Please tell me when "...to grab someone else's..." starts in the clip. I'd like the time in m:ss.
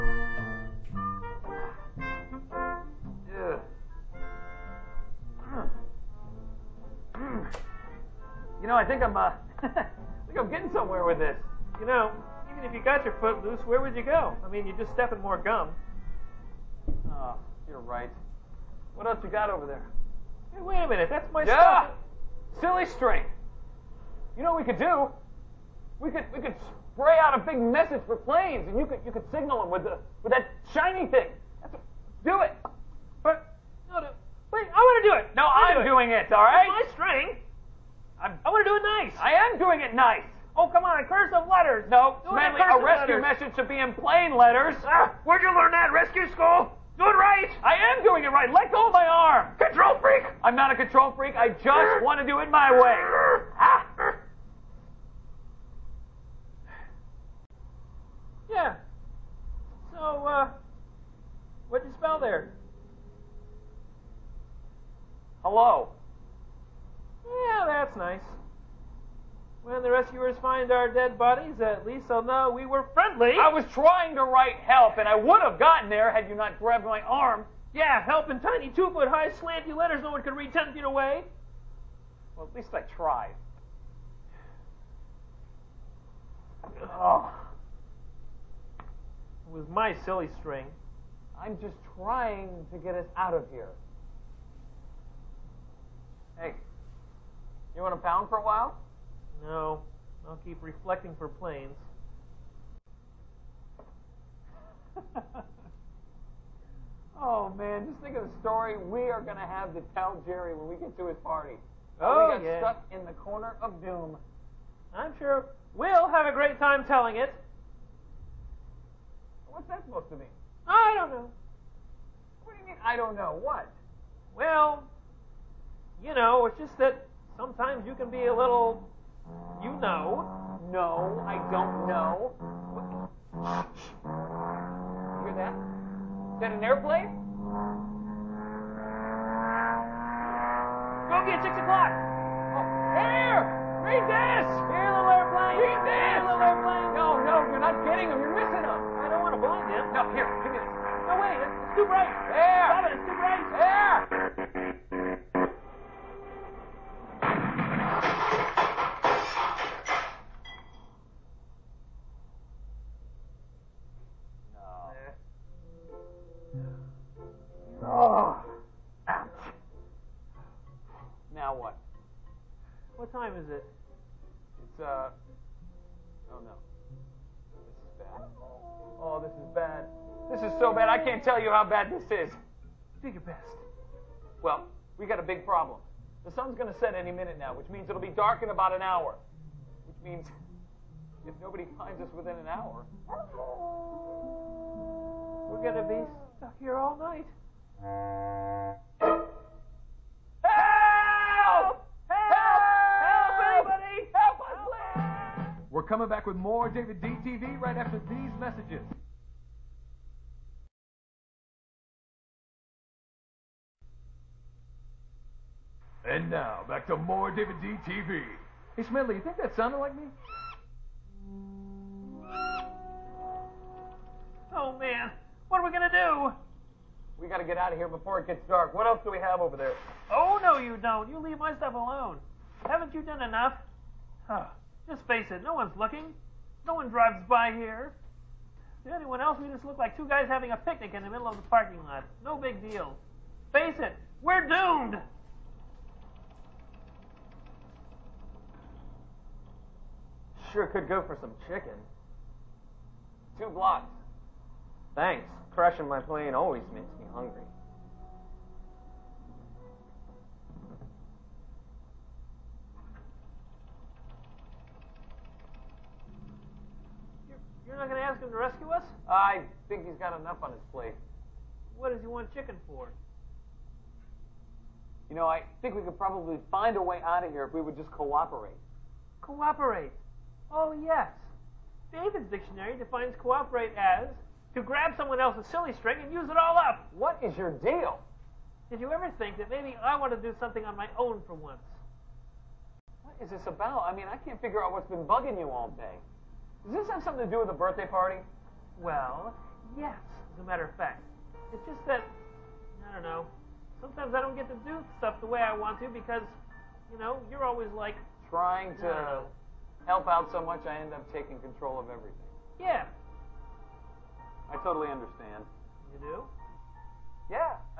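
4:44.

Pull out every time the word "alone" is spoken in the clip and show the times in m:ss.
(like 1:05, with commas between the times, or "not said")
3:51.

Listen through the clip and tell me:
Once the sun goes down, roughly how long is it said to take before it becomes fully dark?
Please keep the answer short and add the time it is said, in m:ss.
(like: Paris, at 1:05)
About an hour, at 3:08.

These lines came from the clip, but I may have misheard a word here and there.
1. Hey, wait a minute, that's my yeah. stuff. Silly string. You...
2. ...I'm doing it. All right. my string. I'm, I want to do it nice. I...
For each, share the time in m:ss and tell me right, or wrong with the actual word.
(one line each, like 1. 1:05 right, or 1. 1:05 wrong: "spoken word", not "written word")
1. 0:20 right
2. 0:35 right.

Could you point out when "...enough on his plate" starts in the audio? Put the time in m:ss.
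4:30.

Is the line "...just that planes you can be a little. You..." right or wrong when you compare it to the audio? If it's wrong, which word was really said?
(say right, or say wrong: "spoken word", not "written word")
wrong: "sometimes", not "planes".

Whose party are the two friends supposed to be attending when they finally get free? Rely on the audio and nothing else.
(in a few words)
Jerry.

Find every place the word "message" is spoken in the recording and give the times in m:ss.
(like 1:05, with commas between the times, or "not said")
0:27, 0:43, 3:28.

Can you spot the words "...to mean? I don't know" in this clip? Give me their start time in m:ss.
2:00.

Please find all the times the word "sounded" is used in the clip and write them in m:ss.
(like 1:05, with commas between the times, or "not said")
3:39.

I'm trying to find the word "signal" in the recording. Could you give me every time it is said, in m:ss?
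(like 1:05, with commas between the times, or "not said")
0:29.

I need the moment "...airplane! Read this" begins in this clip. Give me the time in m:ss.
2:25.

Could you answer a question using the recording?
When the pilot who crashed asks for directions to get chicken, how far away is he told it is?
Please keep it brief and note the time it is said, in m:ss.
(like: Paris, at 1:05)
Two blocks, at 4:13.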